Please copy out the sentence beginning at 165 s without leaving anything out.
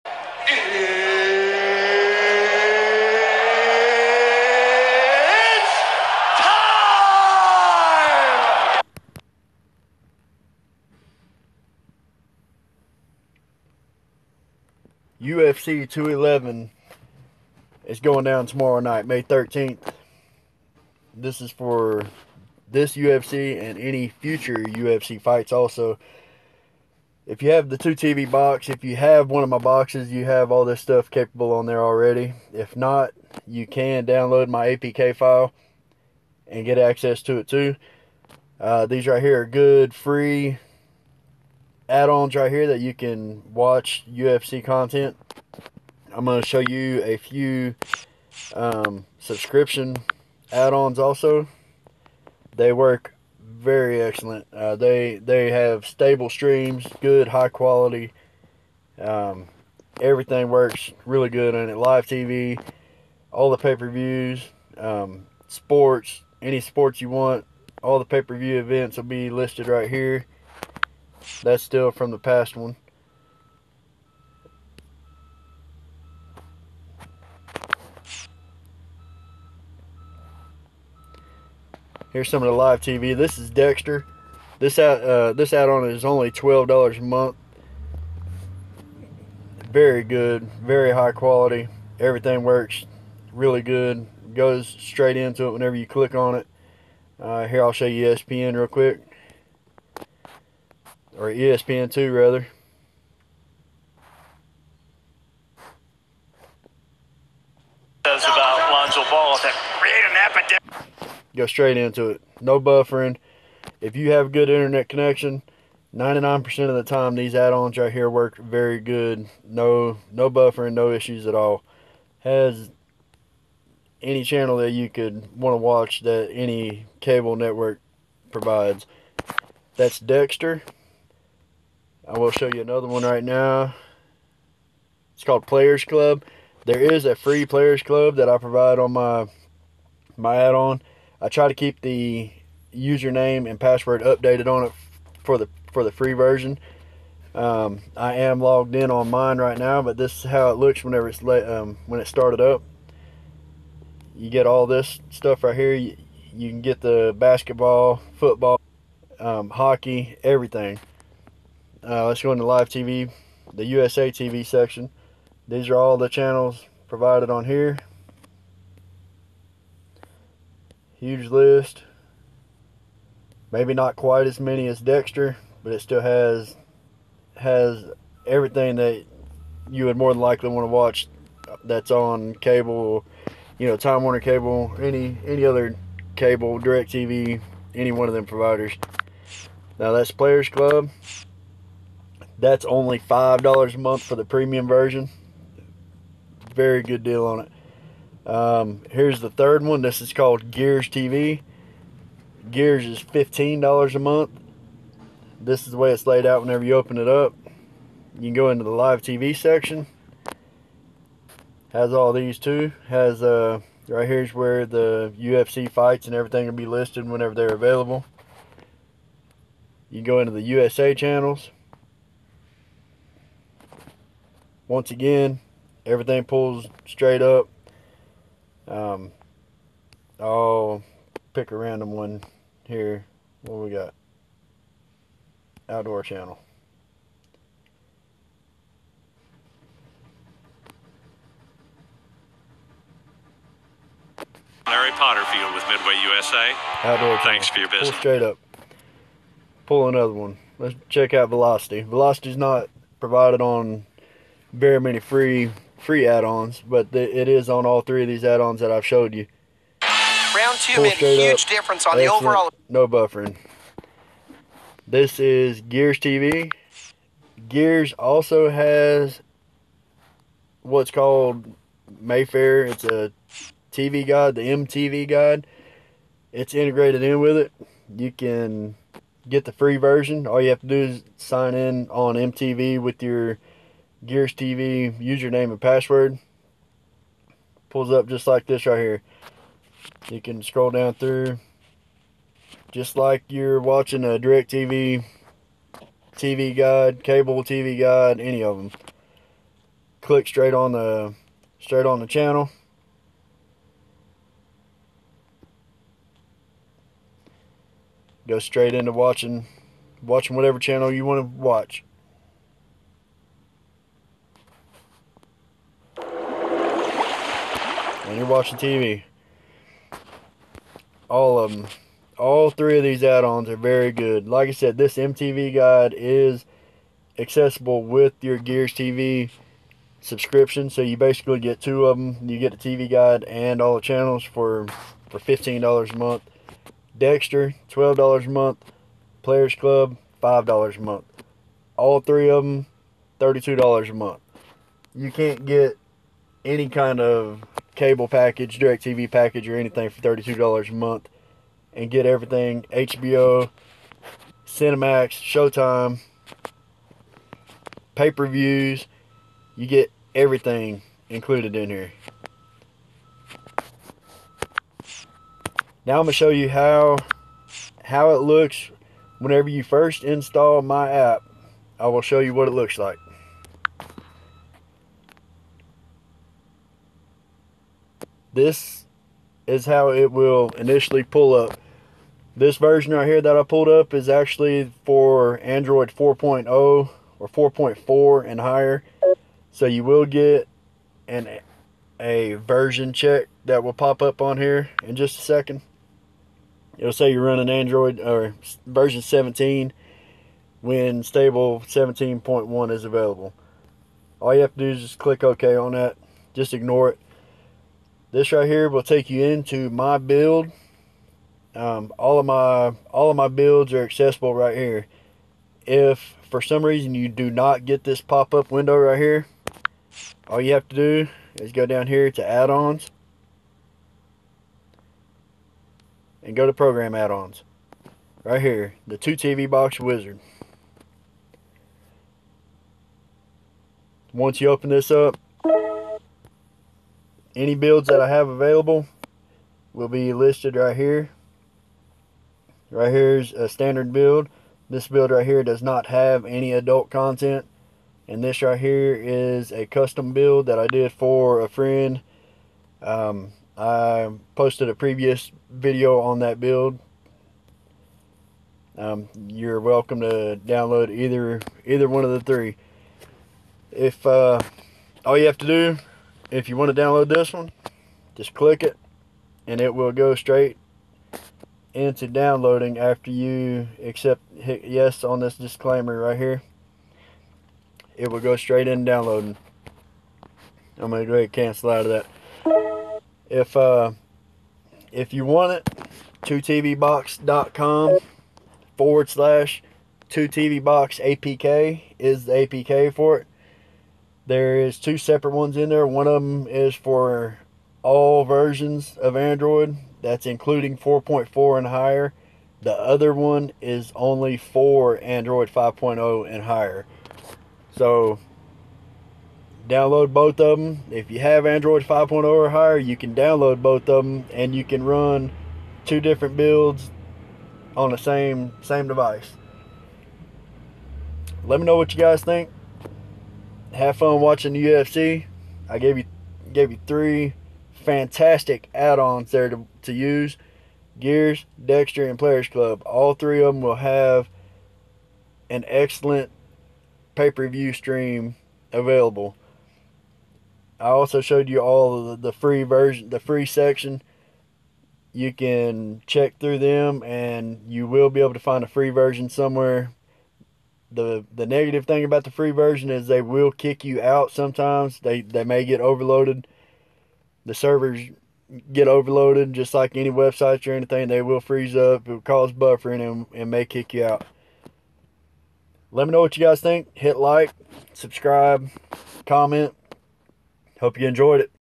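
These are all the channels provided on here.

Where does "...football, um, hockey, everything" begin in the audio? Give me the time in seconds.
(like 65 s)
158 s.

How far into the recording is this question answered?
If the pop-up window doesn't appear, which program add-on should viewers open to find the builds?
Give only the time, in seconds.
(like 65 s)
428 s.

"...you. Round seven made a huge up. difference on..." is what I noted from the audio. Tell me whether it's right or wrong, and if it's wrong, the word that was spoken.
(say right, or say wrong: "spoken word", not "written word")
wrong: "two", not "seven".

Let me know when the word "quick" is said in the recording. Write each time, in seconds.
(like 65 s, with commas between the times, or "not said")
98 s.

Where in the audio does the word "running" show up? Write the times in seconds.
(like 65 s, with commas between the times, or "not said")
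397 s.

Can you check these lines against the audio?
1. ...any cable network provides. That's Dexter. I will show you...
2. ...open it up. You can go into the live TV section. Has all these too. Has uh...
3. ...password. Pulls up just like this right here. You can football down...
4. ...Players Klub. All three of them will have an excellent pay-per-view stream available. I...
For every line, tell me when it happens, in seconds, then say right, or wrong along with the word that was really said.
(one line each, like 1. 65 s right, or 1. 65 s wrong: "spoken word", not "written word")
1. 126 s right
2. 206 s right
3. 285 s wrong: "scroll", not "football"
4. 532 s right.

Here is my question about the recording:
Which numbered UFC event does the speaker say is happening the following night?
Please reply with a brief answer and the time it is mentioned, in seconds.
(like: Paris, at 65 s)
UFC 211, at 15 s.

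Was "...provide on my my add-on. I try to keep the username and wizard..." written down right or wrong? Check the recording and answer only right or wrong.
wrong.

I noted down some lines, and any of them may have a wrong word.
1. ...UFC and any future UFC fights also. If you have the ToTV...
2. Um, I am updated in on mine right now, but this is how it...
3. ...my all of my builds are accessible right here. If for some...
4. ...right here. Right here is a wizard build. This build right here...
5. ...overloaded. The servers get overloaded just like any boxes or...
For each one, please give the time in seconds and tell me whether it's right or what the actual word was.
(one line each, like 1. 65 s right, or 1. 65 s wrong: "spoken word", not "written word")
1. 22 s right
2. 147 s wrong: "logged", not "updated"
3. 412 s right
4. 440 s wrong: "standard", not "wizard"
5. 555 s wrong: "websites", not "boxes".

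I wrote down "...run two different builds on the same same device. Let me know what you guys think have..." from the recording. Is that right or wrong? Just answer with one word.
right.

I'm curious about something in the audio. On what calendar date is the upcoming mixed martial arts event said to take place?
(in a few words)
May 13.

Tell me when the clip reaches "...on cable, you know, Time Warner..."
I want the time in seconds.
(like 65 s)
181 s.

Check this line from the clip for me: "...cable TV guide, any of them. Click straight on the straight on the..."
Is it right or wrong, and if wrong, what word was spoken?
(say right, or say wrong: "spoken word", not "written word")
right.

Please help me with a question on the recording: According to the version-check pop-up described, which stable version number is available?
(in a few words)
17.1.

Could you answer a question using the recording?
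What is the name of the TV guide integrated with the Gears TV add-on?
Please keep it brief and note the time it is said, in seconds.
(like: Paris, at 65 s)
Mayfair, at 271 s.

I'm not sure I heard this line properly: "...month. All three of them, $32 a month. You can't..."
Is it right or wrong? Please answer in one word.
right.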